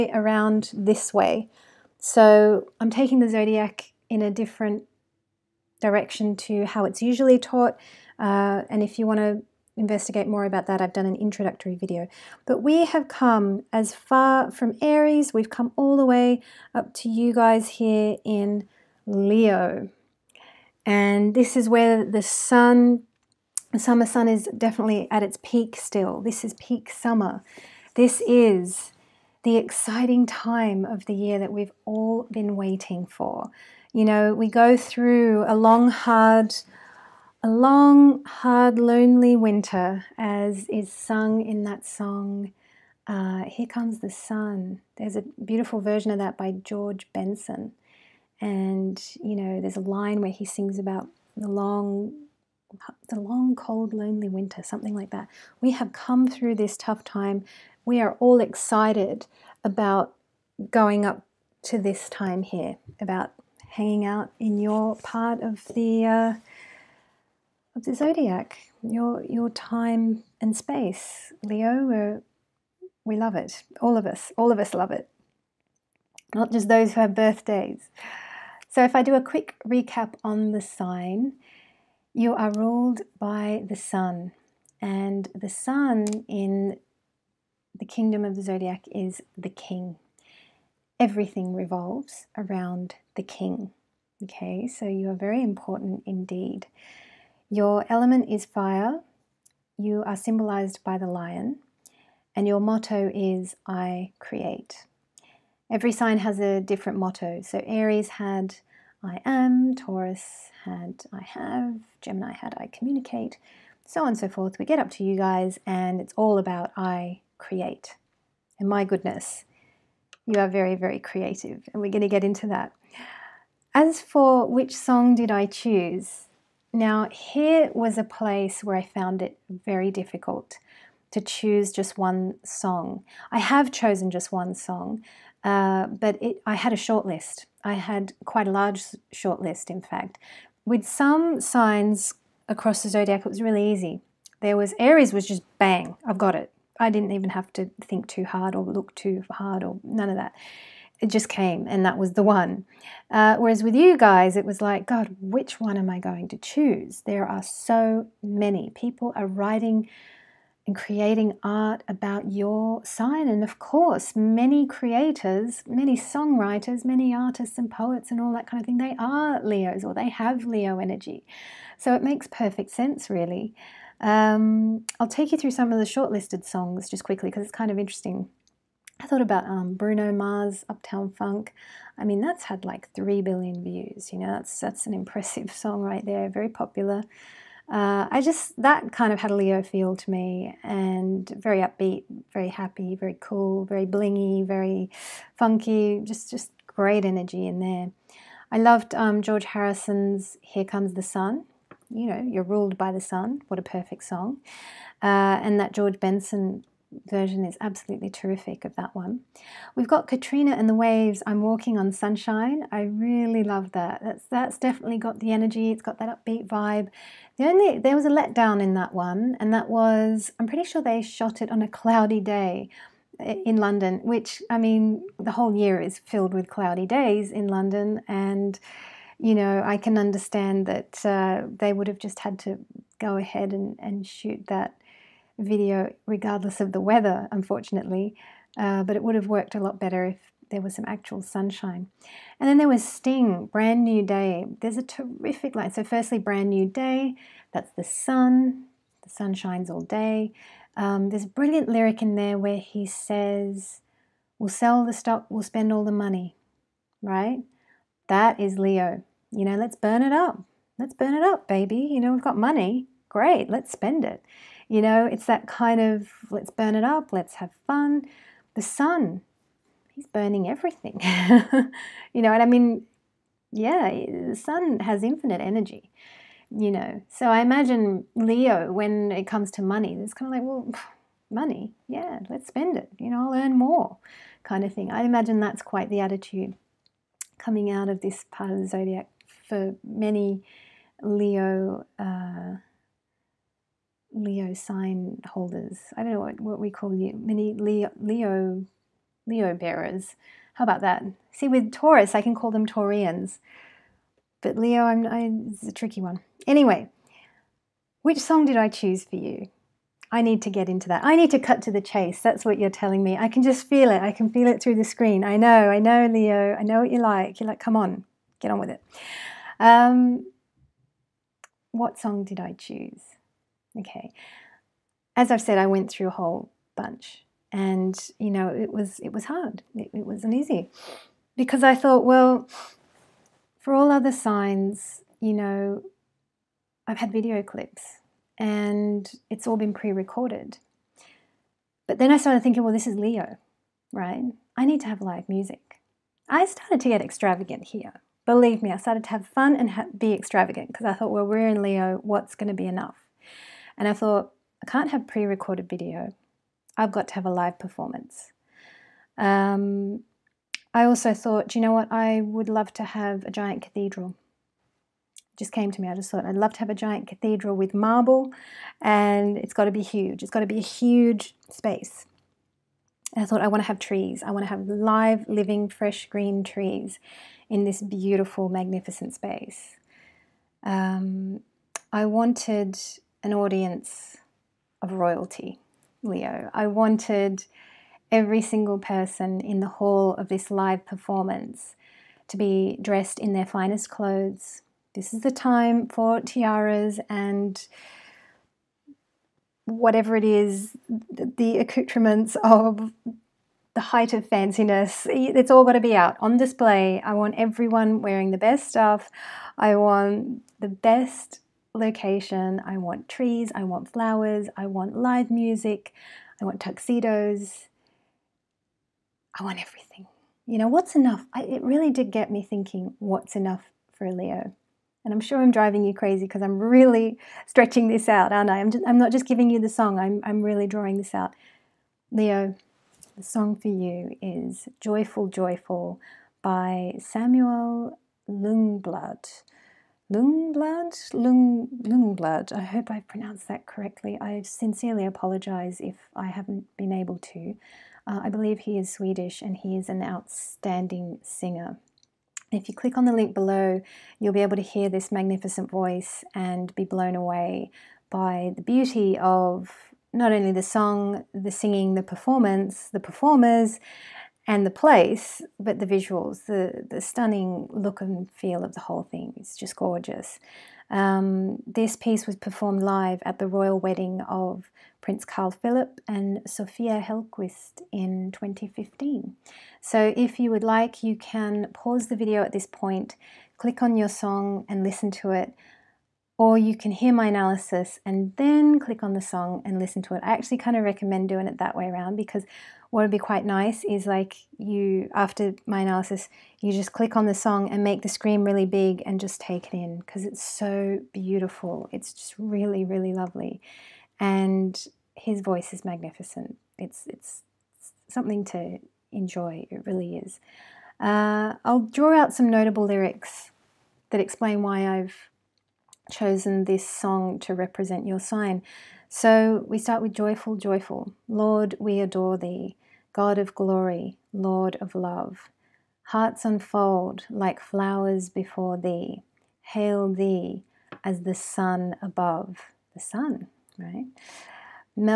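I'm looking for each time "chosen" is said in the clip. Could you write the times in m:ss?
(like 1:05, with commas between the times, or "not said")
2:13, 8:36.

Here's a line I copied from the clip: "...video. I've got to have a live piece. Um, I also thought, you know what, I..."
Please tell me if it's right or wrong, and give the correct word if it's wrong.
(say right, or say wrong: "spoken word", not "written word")
wrong: "performance", not "piece".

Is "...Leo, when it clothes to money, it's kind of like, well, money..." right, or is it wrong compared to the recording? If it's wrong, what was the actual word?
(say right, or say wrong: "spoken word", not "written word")
wrong: "comes", not "clothes".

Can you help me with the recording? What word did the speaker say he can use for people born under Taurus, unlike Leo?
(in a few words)
Taurians.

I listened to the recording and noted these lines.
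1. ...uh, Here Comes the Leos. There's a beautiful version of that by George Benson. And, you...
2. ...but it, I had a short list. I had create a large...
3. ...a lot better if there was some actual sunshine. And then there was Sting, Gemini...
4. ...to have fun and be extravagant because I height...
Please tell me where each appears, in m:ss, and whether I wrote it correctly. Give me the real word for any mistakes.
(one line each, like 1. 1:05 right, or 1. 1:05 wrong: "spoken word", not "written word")
1. 0:43 wrong: "Sun", not "Leos"
2. 2:15 wrong: "quite", not "create"
3. 3:59 wrong: "Brand", not "Gemini"
4. 5:49 wrong: "thought", not "height".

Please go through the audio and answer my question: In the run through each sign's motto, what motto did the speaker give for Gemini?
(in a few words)
I communicate.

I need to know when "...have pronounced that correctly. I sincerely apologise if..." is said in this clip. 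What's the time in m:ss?
7:22.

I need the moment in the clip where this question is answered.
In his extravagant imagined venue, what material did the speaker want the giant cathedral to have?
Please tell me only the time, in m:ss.
6:07.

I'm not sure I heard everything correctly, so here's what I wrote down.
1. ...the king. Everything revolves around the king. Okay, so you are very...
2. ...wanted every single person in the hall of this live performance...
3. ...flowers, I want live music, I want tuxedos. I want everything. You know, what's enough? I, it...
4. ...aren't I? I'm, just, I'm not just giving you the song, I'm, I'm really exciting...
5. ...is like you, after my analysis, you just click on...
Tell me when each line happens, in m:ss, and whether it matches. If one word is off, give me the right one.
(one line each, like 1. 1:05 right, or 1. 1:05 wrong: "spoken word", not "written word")
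1. 1:29 right
2. 6:26 right
3. 6:53 right
4. 7:08 wrong: "drawing", not "exciting"
5. 8:13 right.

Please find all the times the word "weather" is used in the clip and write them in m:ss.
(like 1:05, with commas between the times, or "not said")
3:56.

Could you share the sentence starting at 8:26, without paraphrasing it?
It's, it's, something to enjoy, it really is.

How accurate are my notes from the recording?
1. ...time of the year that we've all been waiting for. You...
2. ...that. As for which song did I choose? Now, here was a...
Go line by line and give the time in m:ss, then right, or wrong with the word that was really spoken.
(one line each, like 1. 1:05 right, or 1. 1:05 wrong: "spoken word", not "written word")
1. 0:30 right
2. 2:02 right.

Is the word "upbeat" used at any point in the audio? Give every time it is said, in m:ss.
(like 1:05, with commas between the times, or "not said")
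3:11, 3:36.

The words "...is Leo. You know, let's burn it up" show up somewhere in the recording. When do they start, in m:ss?
4:18.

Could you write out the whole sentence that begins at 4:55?
I don't know what, what we call you, mini Leo, Leo, Leo bearers.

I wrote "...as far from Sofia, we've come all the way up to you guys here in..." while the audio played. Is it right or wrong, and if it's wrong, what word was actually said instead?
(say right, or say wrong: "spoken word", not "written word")
wrong: "Aries", not "Sofia".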